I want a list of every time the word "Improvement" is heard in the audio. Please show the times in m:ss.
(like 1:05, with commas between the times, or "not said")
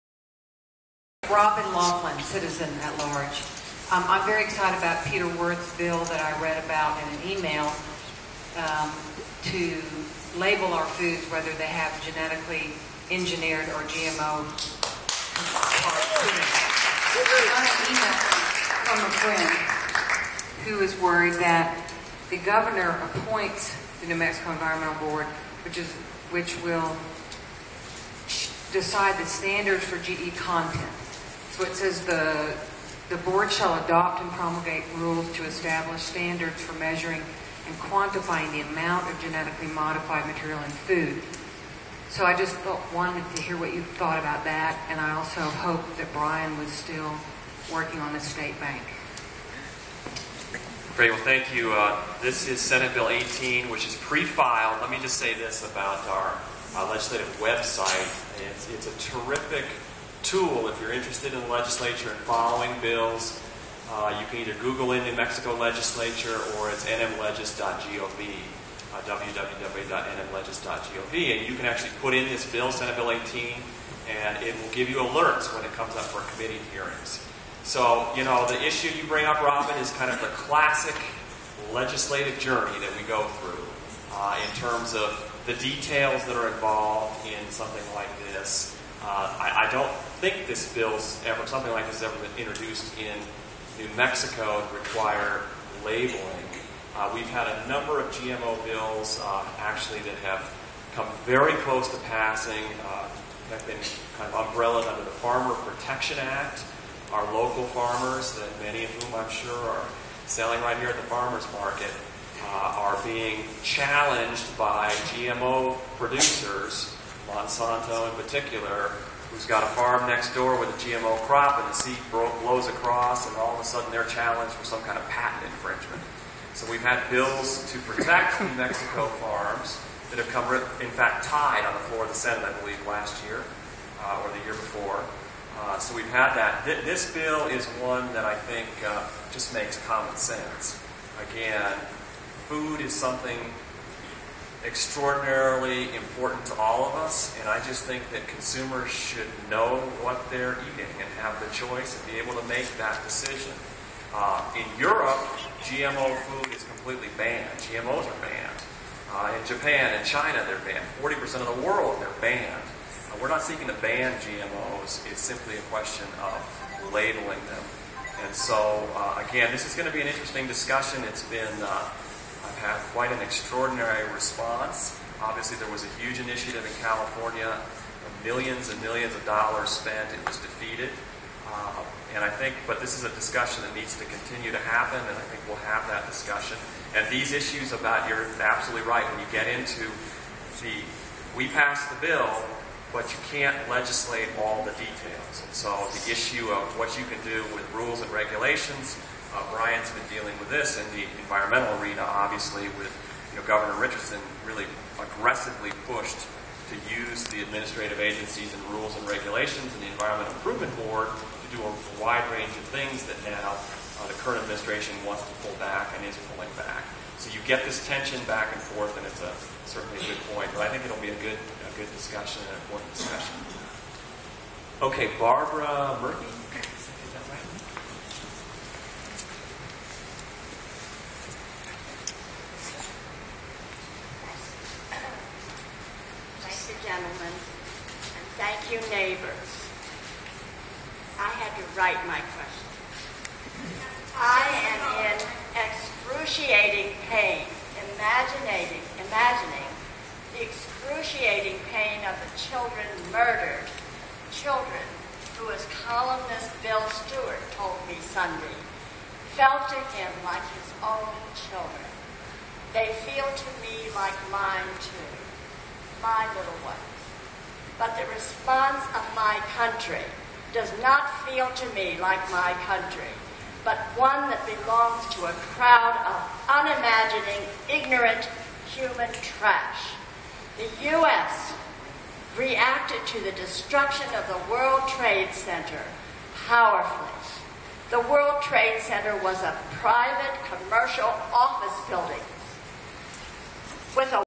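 3:30.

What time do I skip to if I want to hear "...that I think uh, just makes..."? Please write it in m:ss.
2:18.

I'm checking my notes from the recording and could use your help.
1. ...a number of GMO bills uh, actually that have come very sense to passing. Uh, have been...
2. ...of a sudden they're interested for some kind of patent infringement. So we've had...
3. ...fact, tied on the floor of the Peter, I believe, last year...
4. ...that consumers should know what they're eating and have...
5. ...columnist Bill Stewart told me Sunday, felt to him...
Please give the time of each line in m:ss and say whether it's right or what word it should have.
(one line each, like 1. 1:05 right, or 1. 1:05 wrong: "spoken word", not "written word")
1. 1:37 wrong: "close", not "sense"
2. 2:03 wrong: "challenged", not "interested"
3. 2:10 wrong: "Senate", not "Peter"
4. 2:28 right
5. 4:15 right.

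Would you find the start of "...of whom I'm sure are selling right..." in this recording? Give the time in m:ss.
1:48.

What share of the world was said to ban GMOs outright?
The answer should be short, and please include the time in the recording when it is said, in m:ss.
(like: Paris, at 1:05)
40%, at 2:41.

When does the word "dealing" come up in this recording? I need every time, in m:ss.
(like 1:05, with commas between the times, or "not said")
3:20.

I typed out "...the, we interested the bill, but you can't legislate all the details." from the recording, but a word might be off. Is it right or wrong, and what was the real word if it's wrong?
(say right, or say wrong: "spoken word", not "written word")
wrong: "passed", not "interested".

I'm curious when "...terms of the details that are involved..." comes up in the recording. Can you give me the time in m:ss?
1:24.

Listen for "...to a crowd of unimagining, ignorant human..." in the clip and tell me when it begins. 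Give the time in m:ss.
4:35.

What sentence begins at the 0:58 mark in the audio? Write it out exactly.
It's, it's a terrific tool if you're interested in legislature and following bills.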